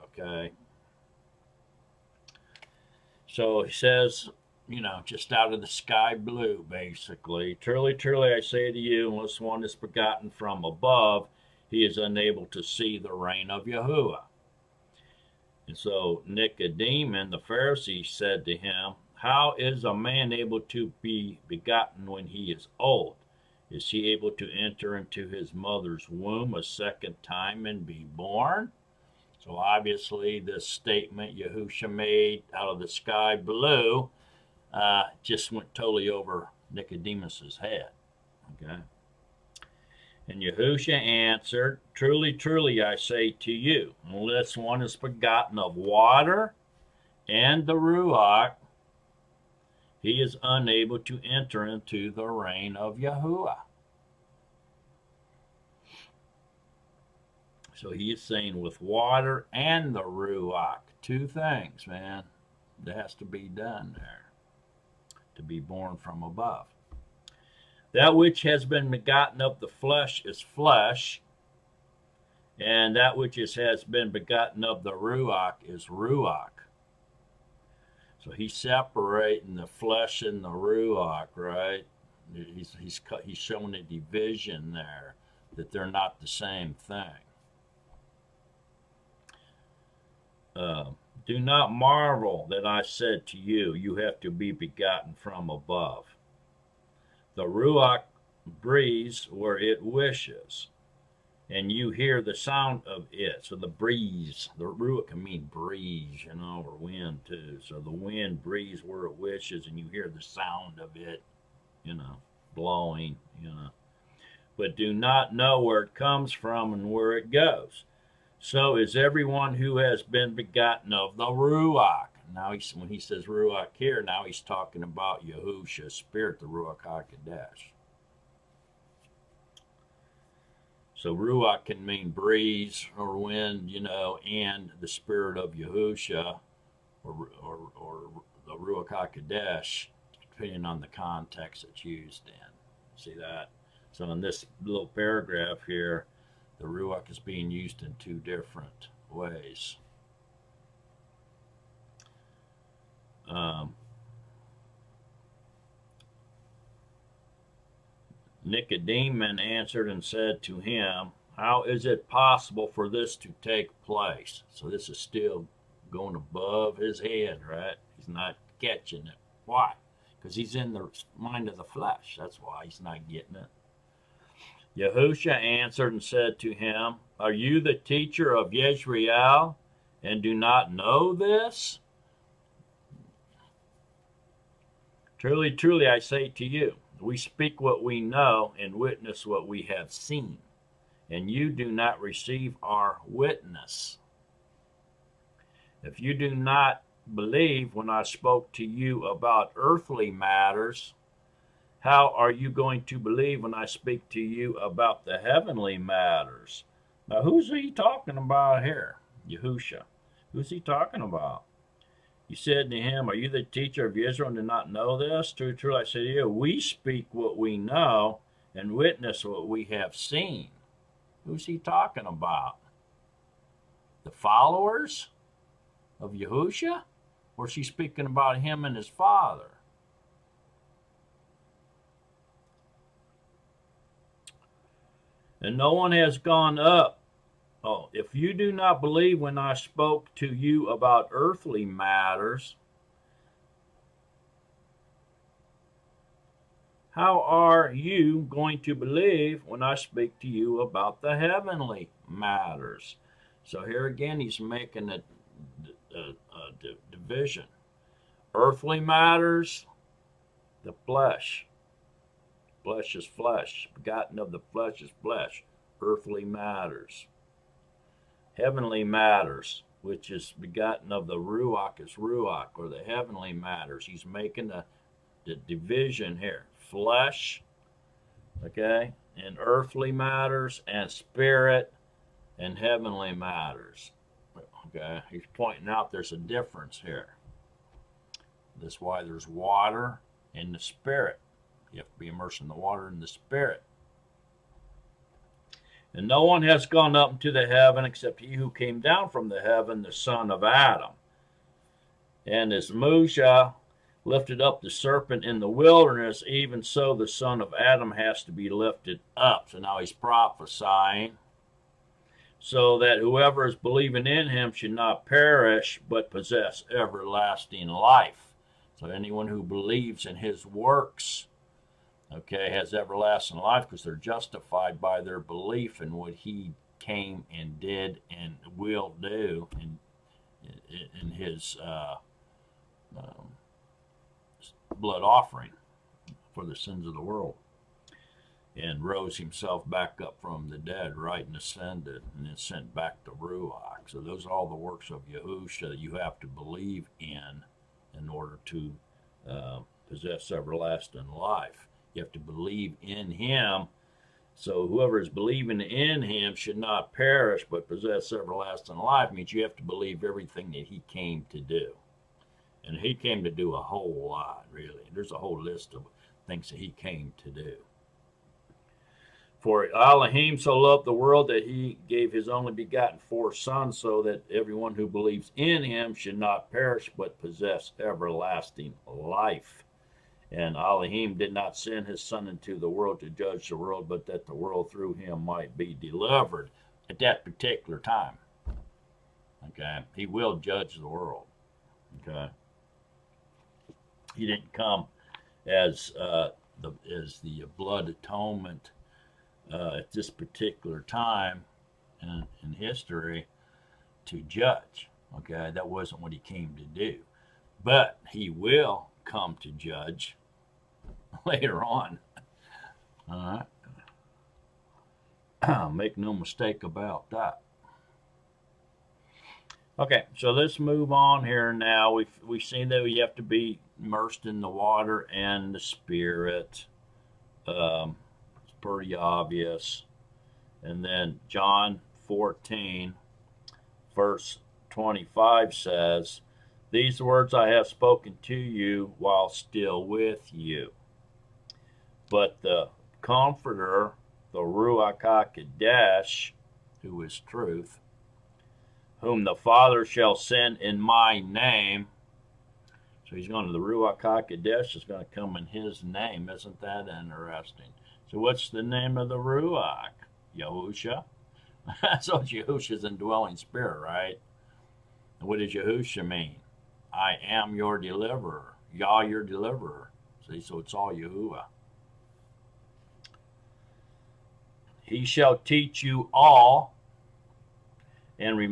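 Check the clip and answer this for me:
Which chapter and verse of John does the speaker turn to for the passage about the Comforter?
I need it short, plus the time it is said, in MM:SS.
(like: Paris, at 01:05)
John 14:25, at 07:11.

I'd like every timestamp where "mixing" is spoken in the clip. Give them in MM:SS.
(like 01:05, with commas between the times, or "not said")
not said.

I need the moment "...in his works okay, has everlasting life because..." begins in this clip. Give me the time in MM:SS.
05:20.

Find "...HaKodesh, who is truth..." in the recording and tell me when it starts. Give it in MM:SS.
07:25.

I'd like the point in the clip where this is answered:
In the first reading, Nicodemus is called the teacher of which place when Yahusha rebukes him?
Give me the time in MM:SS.
02:57.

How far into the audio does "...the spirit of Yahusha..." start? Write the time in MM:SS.
02:14.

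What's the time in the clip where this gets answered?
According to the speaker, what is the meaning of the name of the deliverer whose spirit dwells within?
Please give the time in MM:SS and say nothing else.
07:46.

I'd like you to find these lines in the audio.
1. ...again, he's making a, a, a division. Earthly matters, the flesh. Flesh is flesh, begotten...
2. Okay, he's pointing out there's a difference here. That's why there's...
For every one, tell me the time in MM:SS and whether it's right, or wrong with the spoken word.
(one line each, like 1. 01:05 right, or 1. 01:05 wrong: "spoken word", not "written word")
1. 04:13 right
2. 04:44 right.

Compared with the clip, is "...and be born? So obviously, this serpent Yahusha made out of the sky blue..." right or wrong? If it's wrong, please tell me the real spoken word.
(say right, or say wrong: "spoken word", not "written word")
wrong: "statement", not "serpent".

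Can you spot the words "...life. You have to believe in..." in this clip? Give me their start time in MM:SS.
05:51.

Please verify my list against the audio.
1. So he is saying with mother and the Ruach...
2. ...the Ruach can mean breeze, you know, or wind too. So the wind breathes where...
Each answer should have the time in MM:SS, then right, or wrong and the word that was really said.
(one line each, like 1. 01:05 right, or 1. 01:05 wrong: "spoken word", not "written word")
1. 00:57 wrong: "water", not "mother"
2. 01:44 right.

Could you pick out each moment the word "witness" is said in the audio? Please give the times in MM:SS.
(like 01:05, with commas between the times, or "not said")
03:08, 03:13, 03:38.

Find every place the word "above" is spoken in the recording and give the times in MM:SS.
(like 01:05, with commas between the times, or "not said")
00:10, 01:06, 01:35, 02:46.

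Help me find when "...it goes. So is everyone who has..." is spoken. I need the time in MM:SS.
01:57.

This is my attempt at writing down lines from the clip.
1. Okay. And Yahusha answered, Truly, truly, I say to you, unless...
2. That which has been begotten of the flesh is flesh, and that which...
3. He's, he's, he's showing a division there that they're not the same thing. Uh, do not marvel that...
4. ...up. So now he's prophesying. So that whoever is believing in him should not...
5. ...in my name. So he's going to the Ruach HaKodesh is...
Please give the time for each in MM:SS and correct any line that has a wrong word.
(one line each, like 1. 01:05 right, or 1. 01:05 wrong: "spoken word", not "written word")
1. 00:38 right
2. 01:07 right
3. 01:22 right
4. 05:09 right
5. 07:30 right.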